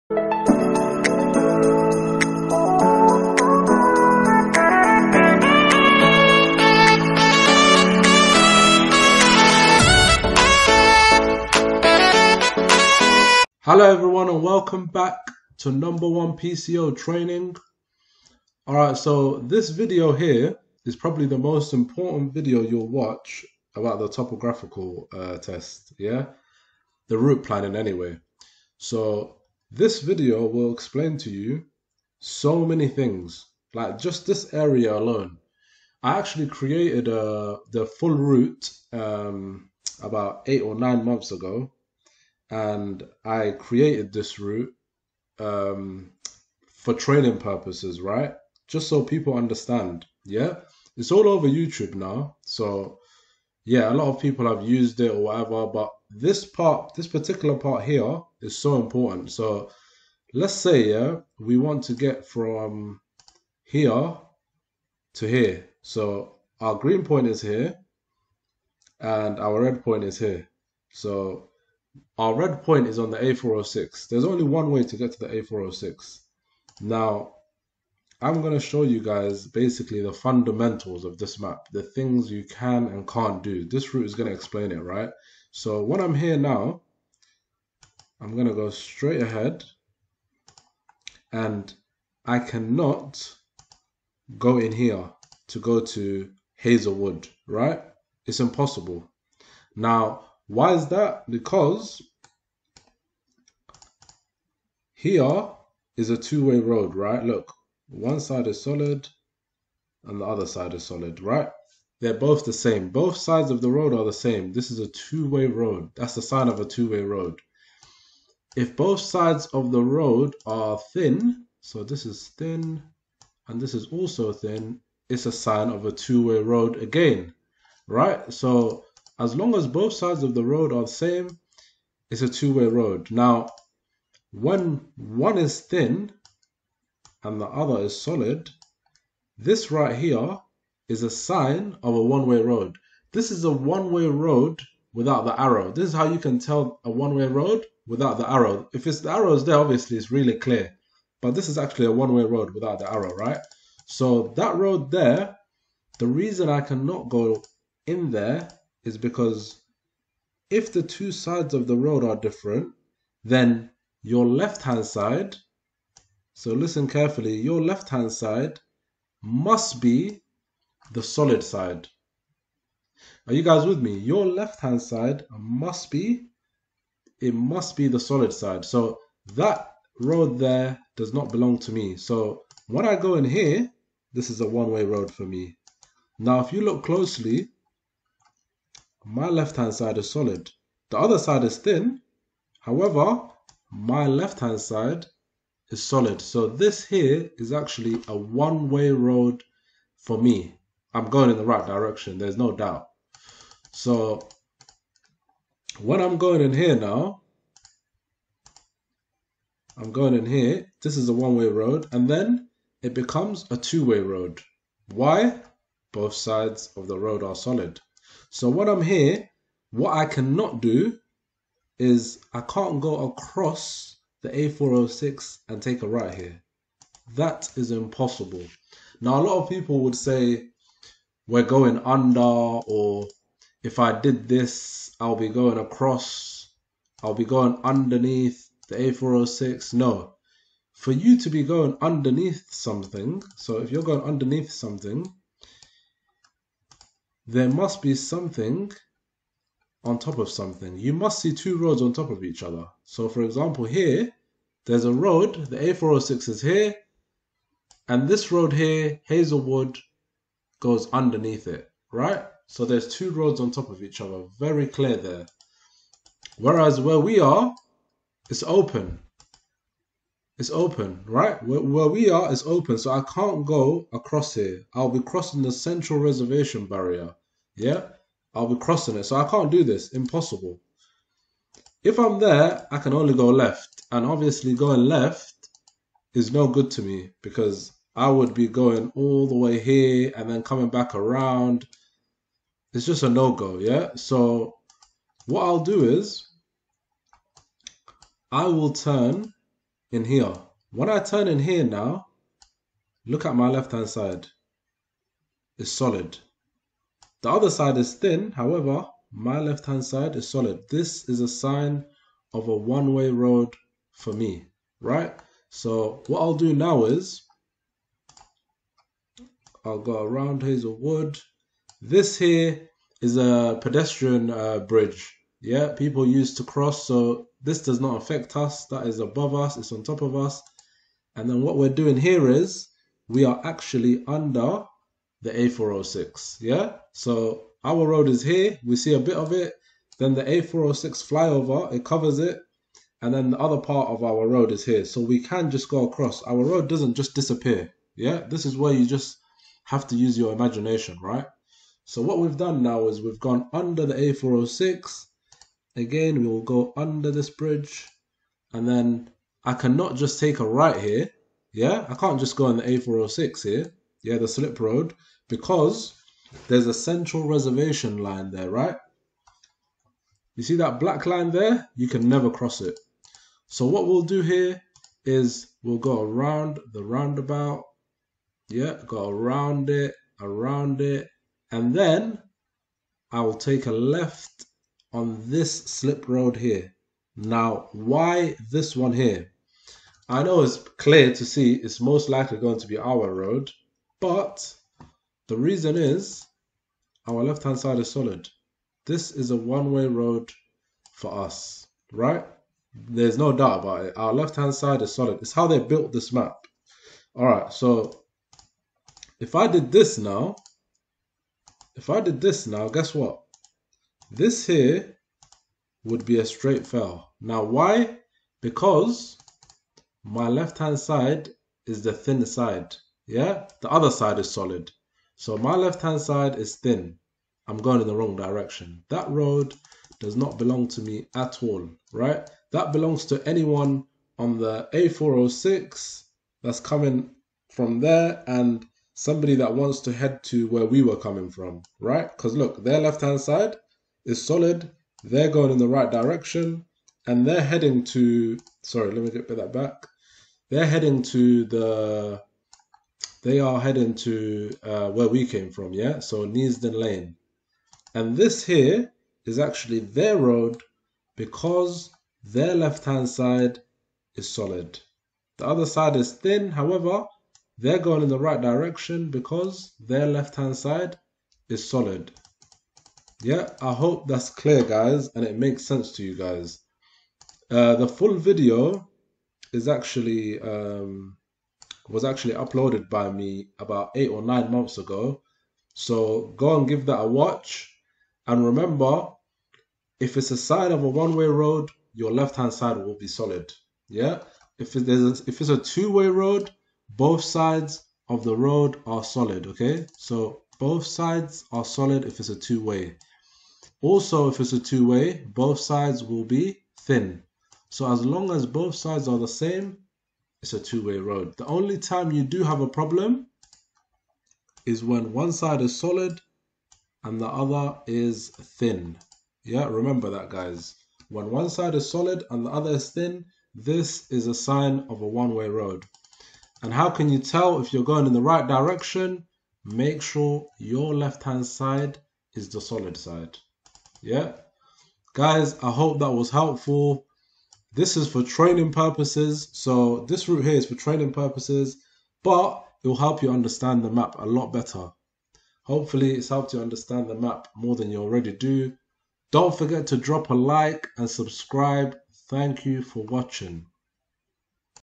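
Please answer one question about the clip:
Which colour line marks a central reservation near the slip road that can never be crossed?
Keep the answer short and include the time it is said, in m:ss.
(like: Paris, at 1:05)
black, at 6:10.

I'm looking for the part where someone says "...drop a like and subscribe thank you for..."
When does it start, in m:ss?
9:09.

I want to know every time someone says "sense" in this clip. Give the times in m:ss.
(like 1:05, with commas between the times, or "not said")
7:55.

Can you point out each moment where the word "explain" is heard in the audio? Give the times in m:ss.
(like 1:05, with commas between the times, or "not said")
0:30, 1:24.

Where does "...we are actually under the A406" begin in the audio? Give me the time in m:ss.
5:33.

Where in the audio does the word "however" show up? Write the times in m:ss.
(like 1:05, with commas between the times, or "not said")
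3:12, 5:08, 7:46.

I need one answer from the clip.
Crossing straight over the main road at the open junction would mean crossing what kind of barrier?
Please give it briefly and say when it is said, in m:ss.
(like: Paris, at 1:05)
central reservation barrier, at 4:35.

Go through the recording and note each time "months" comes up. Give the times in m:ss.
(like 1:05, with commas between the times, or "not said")
0:41, 8:04.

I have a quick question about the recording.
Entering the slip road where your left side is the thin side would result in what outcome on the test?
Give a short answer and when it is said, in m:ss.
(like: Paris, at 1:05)
straight fail, at 6:56.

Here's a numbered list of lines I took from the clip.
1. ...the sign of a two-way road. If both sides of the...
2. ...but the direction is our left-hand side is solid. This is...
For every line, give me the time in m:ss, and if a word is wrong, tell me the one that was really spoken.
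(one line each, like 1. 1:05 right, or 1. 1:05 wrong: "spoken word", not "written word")
1. 1:56 right
2. 6:33 wrong: "reason", not "direction".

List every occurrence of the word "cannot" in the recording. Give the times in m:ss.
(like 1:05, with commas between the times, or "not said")
1:32, 2:36, 3:40, 5:59.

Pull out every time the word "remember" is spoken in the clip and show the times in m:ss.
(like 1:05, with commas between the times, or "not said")
8:08, 8:39.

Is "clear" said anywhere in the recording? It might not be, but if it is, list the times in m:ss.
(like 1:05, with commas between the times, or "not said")
2:30, 4:24, 6:30, 7:54.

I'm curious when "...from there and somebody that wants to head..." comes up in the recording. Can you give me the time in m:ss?
7:17.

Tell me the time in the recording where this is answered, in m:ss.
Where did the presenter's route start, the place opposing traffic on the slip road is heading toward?
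7:36.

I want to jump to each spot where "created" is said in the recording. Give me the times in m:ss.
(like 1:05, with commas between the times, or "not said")
0:36, 0:43.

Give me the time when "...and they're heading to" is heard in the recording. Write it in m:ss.
7:27.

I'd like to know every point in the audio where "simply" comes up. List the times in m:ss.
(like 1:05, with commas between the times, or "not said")
not said.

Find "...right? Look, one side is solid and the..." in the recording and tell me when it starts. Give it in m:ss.
1:46.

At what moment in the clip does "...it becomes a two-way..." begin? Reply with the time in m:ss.
3:32.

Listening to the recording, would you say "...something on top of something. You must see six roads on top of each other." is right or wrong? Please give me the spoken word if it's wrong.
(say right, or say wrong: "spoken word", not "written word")
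wrong: "two", not "six".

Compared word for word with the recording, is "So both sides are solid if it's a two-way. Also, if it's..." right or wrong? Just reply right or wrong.
right.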